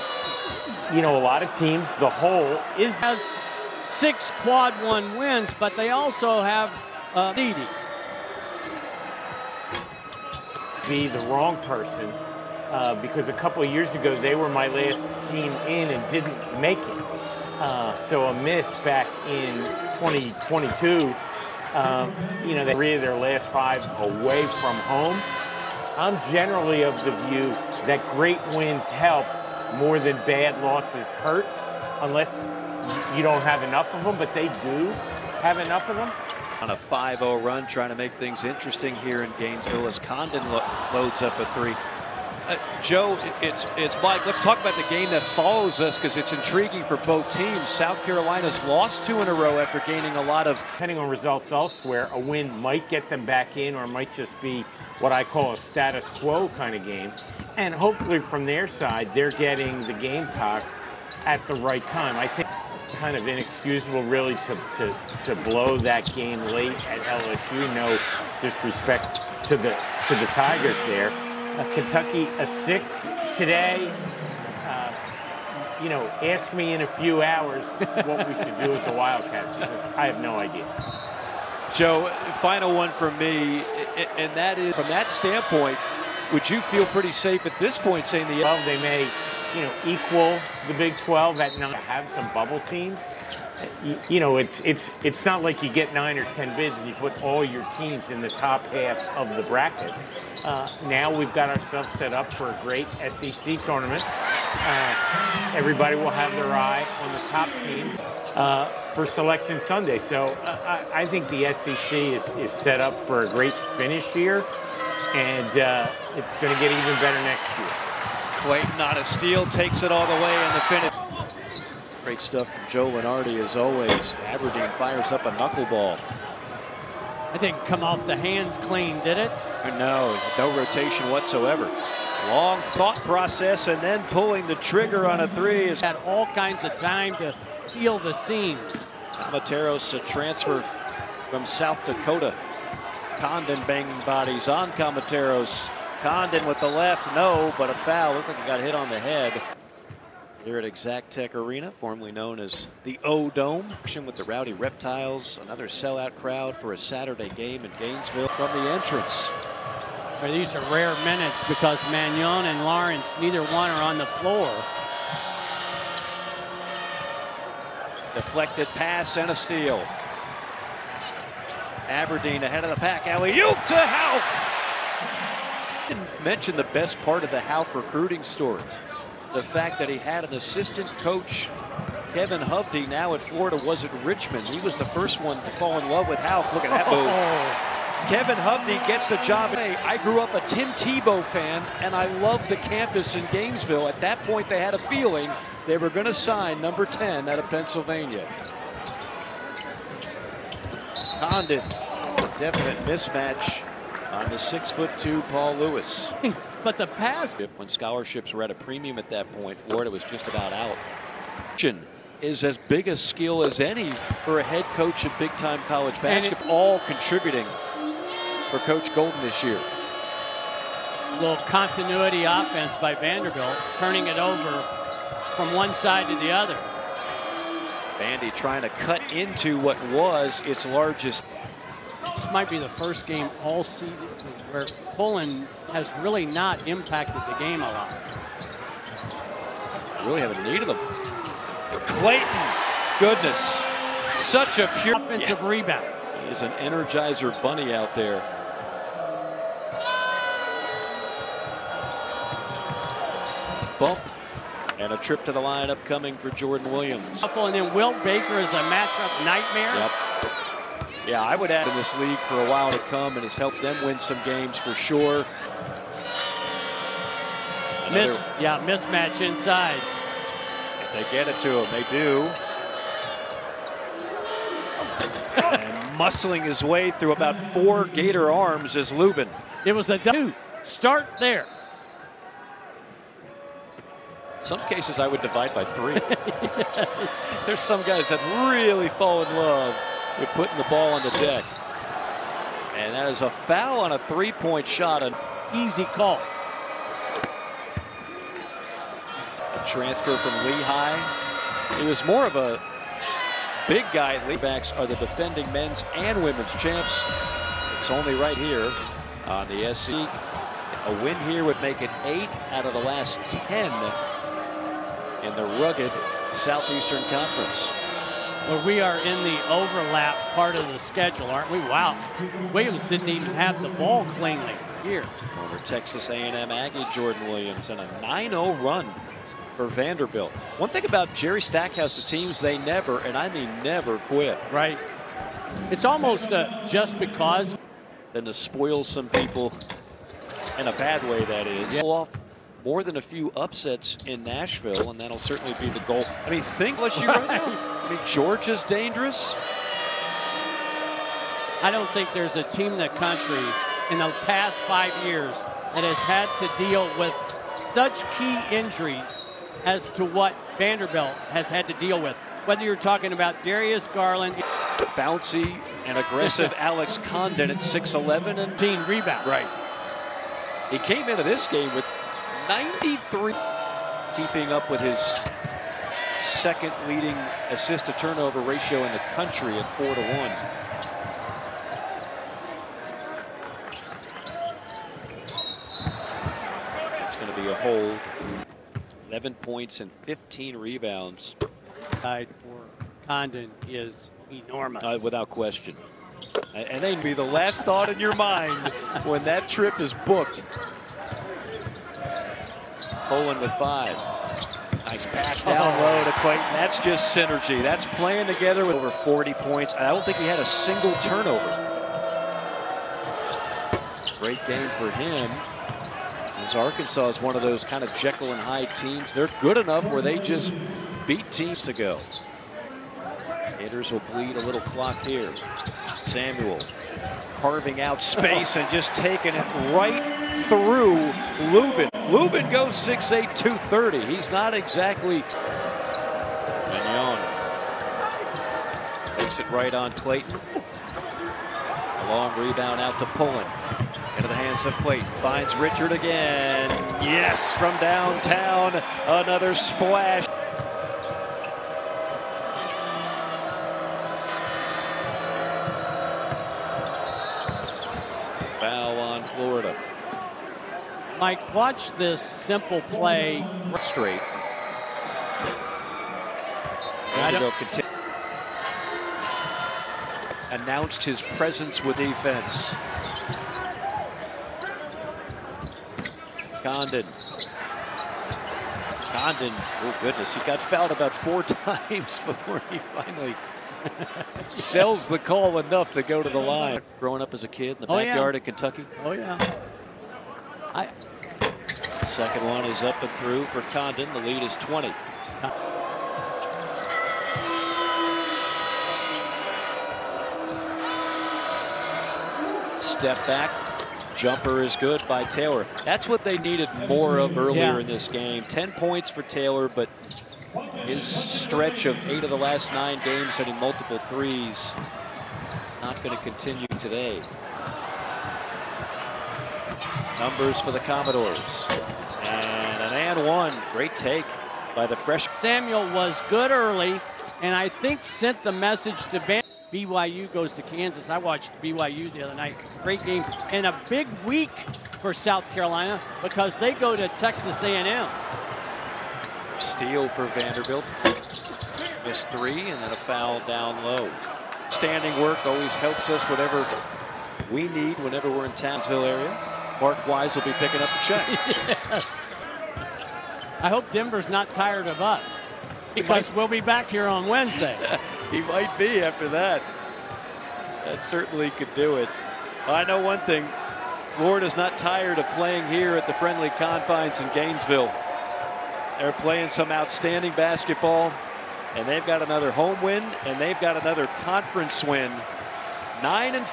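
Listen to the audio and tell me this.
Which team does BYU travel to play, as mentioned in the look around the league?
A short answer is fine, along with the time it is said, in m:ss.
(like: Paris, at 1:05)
Kansas, at 8:50.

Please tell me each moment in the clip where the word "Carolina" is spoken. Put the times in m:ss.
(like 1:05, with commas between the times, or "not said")
0:48, 8:55.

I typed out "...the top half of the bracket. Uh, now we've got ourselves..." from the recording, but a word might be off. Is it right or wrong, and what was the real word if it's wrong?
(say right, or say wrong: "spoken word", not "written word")
right.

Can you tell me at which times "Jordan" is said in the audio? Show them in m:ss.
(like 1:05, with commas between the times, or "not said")
4:16, 5:26.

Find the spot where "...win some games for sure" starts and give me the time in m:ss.
4:23.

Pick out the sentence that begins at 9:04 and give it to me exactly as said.
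Standing work always helps us whatever we need whenever we're in Townsville area.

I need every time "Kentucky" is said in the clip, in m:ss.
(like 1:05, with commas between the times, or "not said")
1:11, 8:08.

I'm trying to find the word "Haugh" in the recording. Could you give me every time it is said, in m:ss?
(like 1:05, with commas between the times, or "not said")
2:57, 3:06.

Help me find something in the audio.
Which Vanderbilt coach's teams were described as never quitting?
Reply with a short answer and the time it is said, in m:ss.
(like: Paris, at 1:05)
Jerry Stackhouse, at 5:31.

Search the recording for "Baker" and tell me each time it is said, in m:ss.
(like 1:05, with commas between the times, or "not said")
4:18.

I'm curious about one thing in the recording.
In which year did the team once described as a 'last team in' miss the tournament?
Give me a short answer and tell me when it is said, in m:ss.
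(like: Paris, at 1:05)
2022, at 0:19.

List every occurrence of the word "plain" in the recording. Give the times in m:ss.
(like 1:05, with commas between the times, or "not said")
not said.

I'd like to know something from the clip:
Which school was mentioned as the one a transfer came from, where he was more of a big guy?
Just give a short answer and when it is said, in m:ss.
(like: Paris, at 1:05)
Lehigh, at 5:00.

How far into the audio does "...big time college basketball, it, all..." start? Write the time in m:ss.
3:35.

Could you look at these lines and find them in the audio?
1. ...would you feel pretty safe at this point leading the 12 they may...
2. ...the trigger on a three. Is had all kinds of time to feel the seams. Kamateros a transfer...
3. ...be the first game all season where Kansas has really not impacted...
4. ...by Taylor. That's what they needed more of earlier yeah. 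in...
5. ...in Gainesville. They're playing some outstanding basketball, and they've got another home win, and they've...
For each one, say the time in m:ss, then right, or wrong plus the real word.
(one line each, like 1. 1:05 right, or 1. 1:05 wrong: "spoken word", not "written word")
1. 1:26 wrong: "saying", not "leading"
2. 2:14 right
3. 3:52 wrong: "Pullin", not "Kansas"
4. 8:25 right
5. 9:27 right.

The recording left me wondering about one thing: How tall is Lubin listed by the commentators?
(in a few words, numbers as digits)
6'8".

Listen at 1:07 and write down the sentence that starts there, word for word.
No disrespect to the to the Tigers there.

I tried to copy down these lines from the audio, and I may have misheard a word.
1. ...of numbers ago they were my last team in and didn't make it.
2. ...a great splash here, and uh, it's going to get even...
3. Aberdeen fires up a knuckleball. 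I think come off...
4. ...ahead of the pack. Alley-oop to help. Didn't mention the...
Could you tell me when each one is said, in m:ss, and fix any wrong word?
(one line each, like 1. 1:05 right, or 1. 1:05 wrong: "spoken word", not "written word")
1. 0:13 wrong: "years", not "numbers"
2. 1:53 wrong: "finish", not "splash"
3. 2:04 right
4. 2:52 right.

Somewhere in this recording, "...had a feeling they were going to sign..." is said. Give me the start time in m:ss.
3:14.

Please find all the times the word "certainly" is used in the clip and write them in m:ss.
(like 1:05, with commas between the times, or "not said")
5:45, 9:21.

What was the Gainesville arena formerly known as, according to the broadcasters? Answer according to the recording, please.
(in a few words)
O-Dome.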